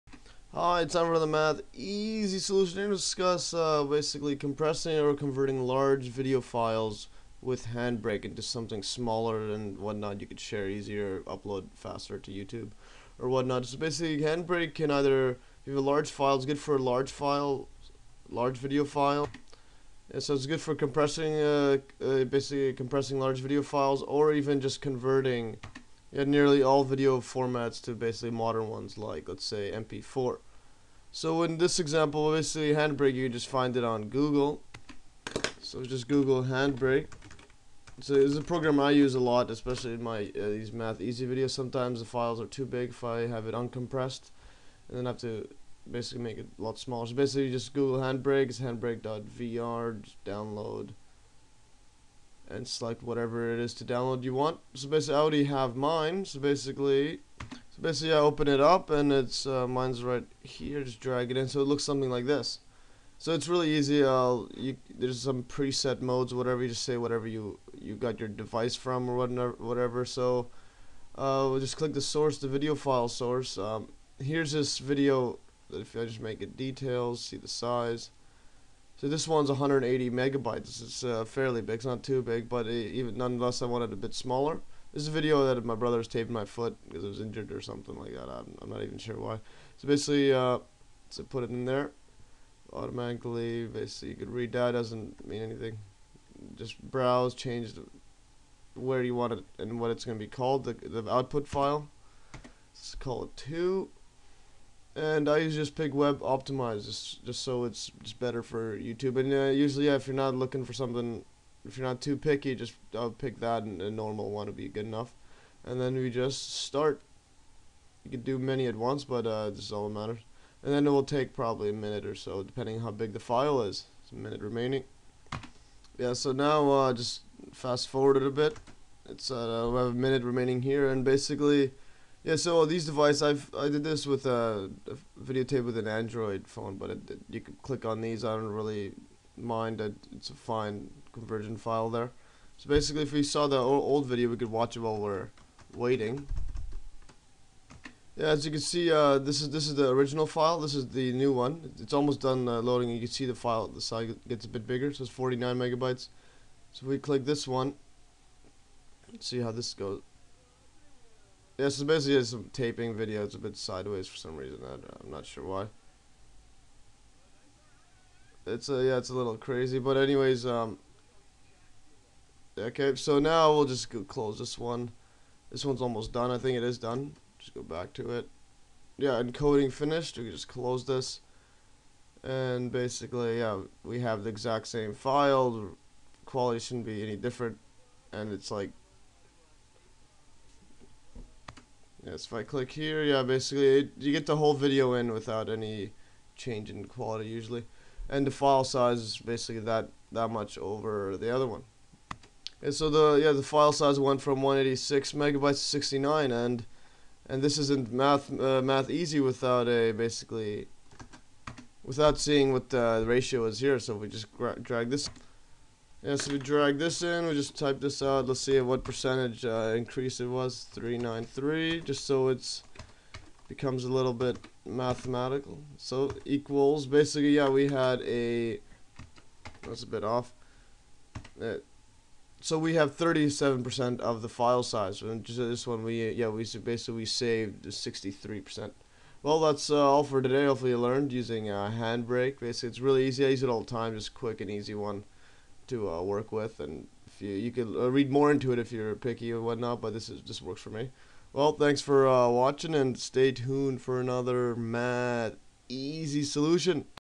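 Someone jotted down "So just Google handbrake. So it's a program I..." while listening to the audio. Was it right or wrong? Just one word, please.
right.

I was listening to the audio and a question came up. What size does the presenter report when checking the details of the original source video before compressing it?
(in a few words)
180 megabytes.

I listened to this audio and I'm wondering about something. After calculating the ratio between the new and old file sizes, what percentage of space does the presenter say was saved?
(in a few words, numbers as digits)
63%.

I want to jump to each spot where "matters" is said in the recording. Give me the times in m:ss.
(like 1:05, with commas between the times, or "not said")
1:59.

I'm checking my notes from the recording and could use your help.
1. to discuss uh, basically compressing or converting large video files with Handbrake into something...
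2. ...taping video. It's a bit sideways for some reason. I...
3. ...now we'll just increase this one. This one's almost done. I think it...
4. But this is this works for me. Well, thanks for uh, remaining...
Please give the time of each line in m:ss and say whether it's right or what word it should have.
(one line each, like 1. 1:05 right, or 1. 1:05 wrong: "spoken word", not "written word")
1. 0:02 right
2. 2:42 right
3. 2:53 wrong: "close", not "increase"
4. 4:09 wrong: "watching", not "remaining".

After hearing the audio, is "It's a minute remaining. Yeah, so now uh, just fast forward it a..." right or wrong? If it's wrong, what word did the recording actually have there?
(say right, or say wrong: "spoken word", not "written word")
right.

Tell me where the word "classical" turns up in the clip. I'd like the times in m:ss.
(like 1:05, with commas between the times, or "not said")
not said.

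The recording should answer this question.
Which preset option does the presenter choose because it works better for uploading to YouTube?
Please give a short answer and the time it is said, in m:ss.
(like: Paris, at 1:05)
web optimized, at 1:45.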